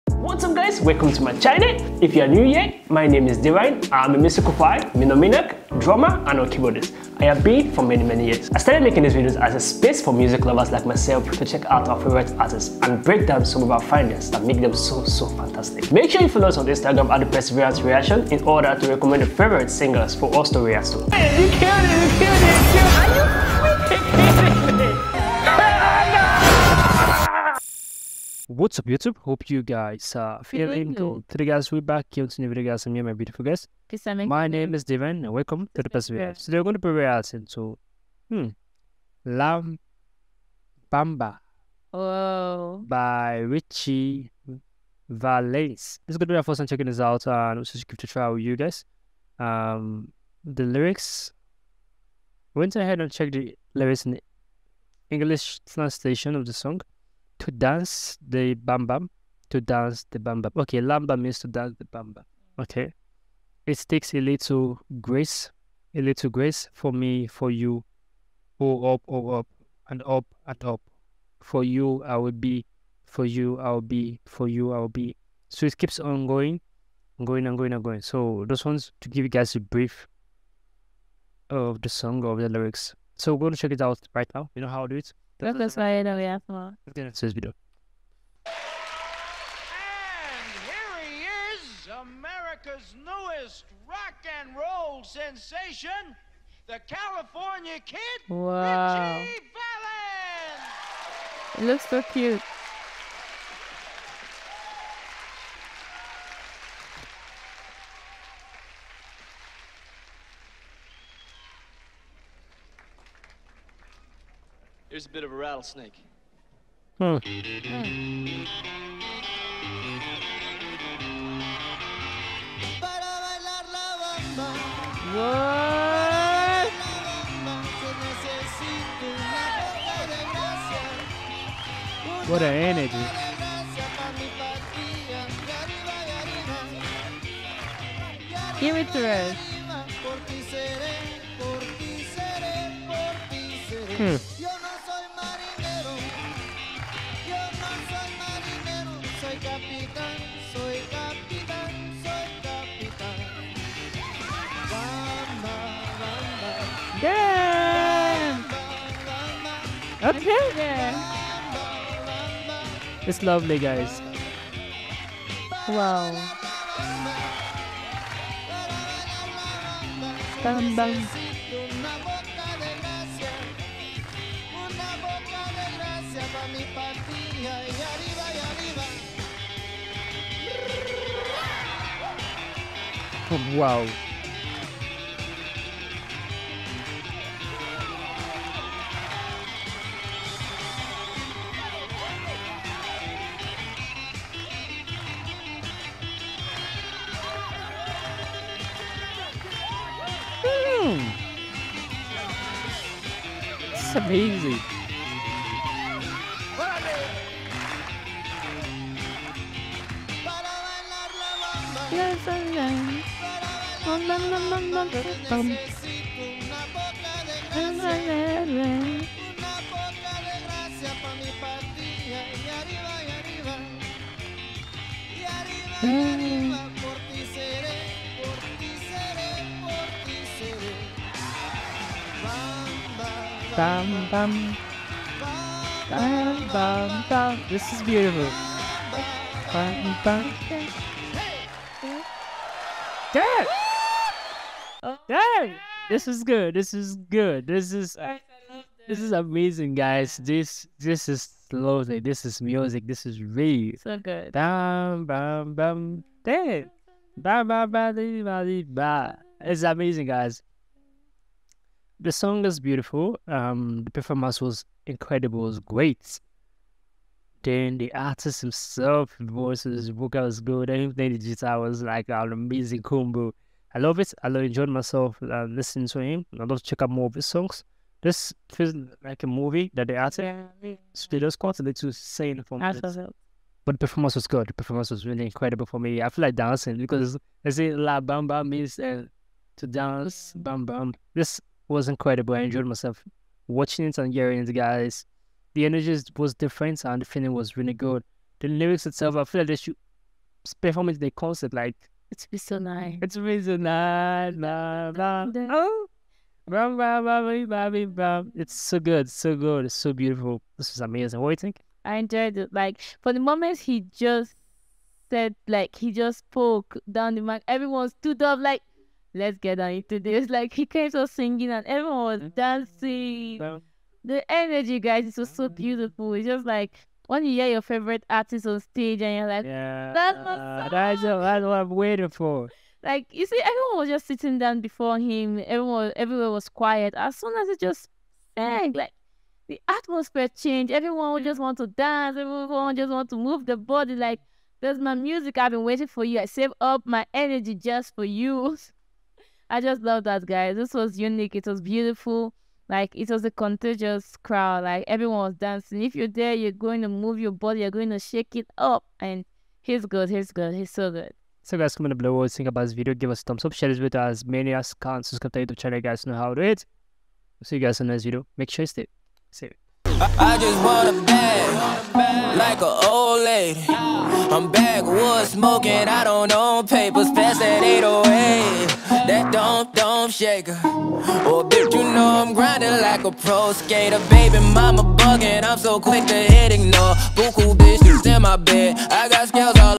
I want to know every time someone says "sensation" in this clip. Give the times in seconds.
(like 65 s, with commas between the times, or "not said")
95 s.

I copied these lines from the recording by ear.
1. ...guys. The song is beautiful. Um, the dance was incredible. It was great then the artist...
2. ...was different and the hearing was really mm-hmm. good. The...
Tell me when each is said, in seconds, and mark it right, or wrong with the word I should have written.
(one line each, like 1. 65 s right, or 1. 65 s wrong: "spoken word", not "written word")
1. 260 s wrong: "performance", not "dance"
2. 296 s wrong: "feeling", not "hearing".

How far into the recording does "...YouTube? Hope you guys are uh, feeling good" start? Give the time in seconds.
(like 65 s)
28 s.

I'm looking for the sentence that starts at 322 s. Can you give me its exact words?
dancing the energy, guys, it was so mm.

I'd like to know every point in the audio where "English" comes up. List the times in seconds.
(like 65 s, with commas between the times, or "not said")
55 s.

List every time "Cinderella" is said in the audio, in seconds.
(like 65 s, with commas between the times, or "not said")
not said.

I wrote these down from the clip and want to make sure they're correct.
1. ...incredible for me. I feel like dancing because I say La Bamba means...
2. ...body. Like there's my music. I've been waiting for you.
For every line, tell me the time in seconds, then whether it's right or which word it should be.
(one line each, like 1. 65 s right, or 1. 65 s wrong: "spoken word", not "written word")
1. 285 s right
2. 343 s right.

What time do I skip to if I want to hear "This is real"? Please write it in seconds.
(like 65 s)
252 s.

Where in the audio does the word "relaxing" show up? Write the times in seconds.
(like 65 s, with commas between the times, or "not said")
not said.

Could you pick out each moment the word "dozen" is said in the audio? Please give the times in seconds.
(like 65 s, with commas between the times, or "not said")
not said.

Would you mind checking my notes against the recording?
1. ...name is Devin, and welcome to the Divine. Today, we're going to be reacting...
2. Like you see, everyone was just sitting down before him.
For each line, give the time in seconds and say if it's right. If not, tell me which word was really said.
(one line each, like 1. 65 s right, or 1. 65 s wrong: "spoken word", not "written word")
1. 34 s wrong: "Perseverance", not "Divine"
2. 332 s right.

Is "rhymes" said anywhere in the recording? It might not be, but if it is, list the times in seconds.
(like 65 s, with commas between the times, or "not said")
not said.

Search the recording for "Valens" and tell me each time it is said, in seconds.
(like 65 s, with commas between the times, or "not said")
45 s, 101 s.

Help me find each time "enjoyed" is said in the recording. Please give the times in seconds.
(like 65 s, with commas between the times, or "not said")
274 s, 292 s, 311 s.